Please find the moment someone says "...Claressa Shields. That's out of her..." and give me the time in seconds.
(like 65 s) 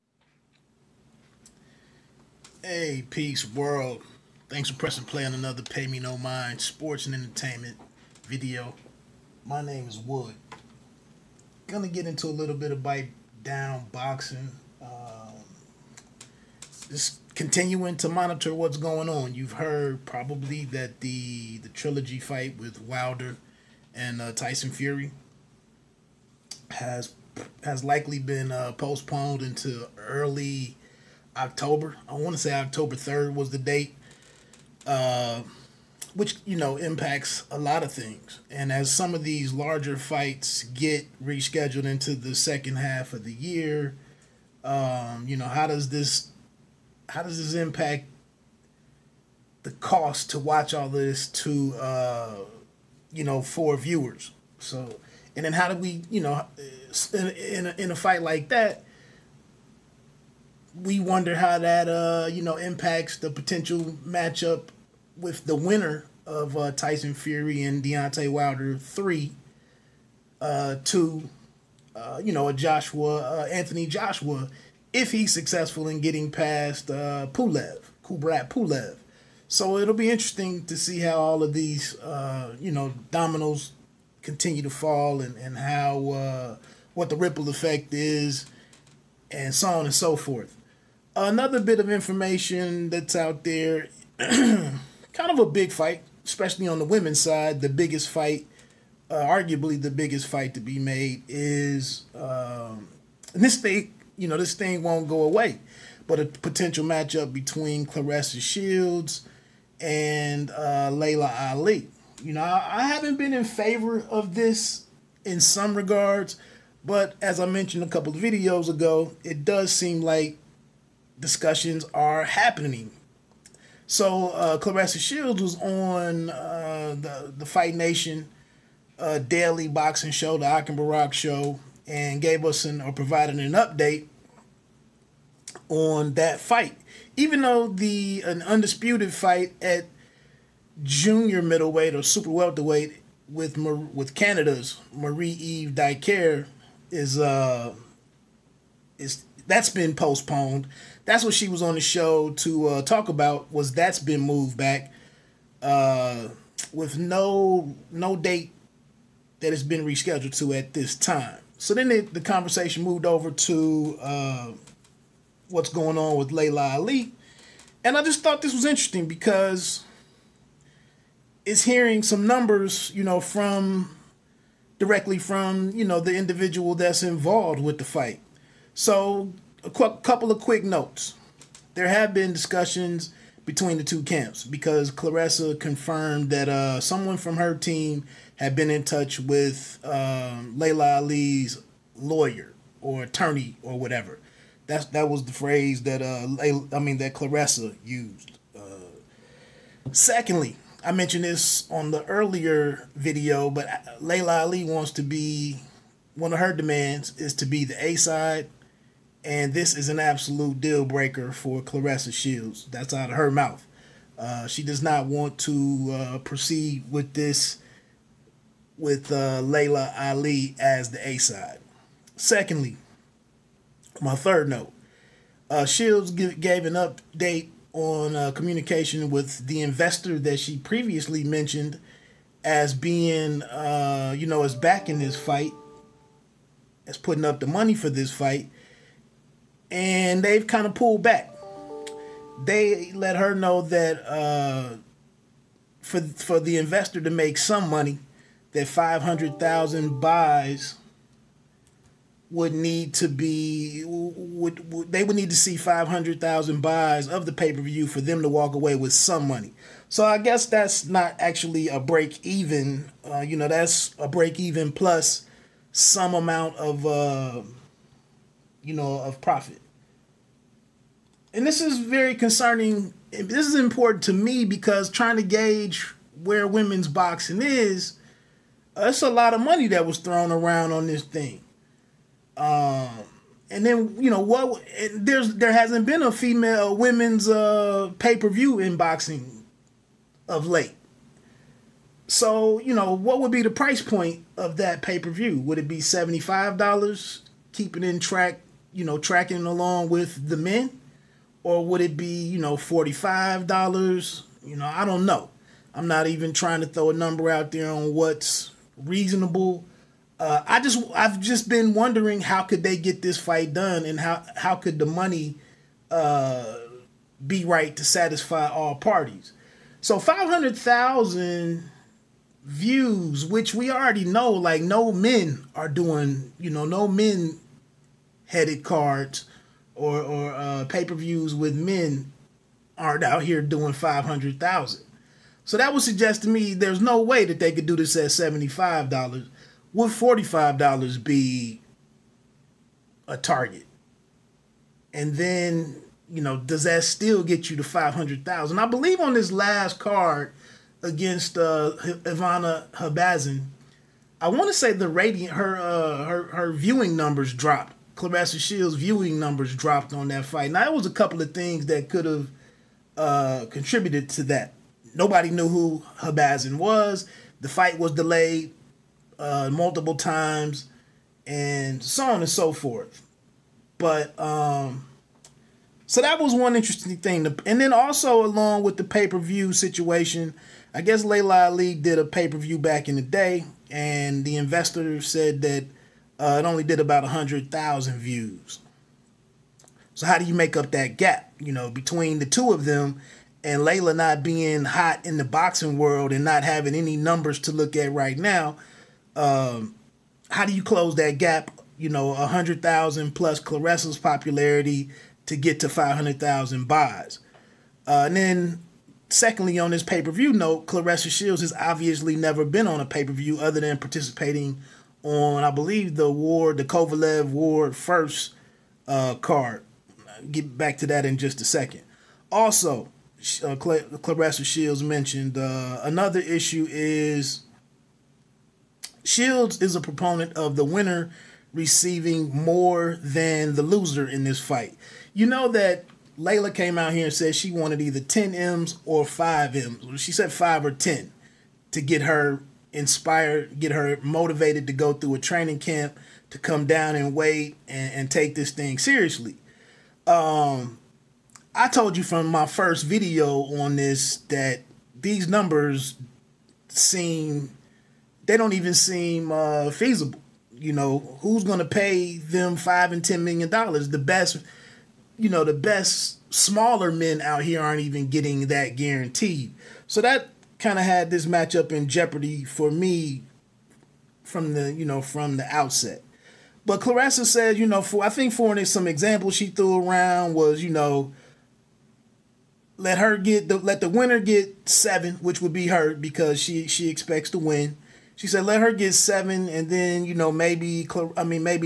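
211 s.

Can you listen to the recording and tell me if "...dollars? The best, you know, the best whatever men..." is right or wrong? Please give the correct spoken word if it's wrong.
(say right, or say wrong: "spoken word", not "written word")
wrong: "smaller", not "whatever".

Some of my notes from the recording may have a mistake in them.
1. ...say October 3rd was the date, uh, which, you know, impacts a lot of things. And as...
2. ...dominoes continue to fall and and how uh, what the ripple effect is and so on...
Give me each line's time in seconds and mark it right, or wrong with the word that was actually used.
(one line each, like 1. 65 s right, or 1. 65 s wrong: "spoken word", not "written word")
1. 32 s right
2. 83 s right.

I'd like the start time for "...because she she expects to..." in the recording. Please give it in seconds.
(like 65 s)
485 s.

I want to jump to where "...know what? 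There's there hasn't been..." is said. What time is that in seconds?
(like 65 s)
284 s.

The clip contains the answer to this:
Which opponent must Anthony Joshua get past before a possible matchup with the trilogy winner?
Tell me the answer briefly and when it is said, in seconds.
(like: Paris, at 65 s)
Kubrat Pulev, at 77 s.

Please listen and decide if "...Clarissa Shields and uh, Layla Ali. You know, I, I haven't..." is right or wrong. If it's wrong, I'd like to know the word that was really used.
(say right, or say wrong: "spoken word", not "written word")
right.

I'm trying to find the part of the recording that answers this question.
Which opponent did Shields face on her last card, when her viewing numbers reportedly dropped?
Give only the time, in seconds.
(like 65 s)
351 s.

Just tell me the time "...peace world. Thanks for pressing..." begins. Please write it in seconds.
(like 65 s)
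3 s.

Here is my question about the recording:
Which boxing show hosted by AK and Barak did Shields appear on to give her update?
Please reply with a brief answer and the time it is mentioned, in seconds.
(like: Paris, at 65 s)
Fight Nation, at 127 s.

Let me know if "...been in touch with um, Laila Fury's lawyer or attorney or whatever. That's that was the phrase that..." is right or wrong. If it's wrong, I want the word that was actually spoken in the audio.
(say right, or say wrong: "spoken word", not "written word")
wrong: "Ali", not "Fury".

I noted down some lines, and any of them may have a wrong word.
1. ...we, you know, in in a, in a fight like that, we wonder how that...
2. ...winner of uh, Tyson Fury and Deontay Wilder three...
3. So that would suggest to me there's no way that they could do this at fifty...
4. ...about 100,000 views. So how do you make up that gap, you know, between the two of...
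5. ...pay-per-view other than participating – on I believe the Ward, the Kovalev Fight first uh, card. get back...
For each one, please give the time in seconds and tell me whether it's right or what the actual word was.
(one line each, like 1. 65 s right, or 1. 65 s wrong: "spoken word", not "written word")
1. 55 s right
2. 65 s right
3. 335 s wrong: "seventy", not "fifty"
4. 386 s right
5. 412 s wrong: "Ward", not "Fight".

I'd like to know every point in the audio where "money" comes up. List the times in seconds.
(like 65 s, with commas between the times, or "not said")
237 s, 247 s, 259 s, 279 s, 314 s.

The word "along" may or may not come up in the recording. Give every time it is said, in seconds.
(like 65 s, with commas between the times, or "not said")
299 s, 378 s.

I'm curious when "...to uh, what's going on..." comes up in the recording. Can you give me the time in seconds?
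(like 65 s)
163 s.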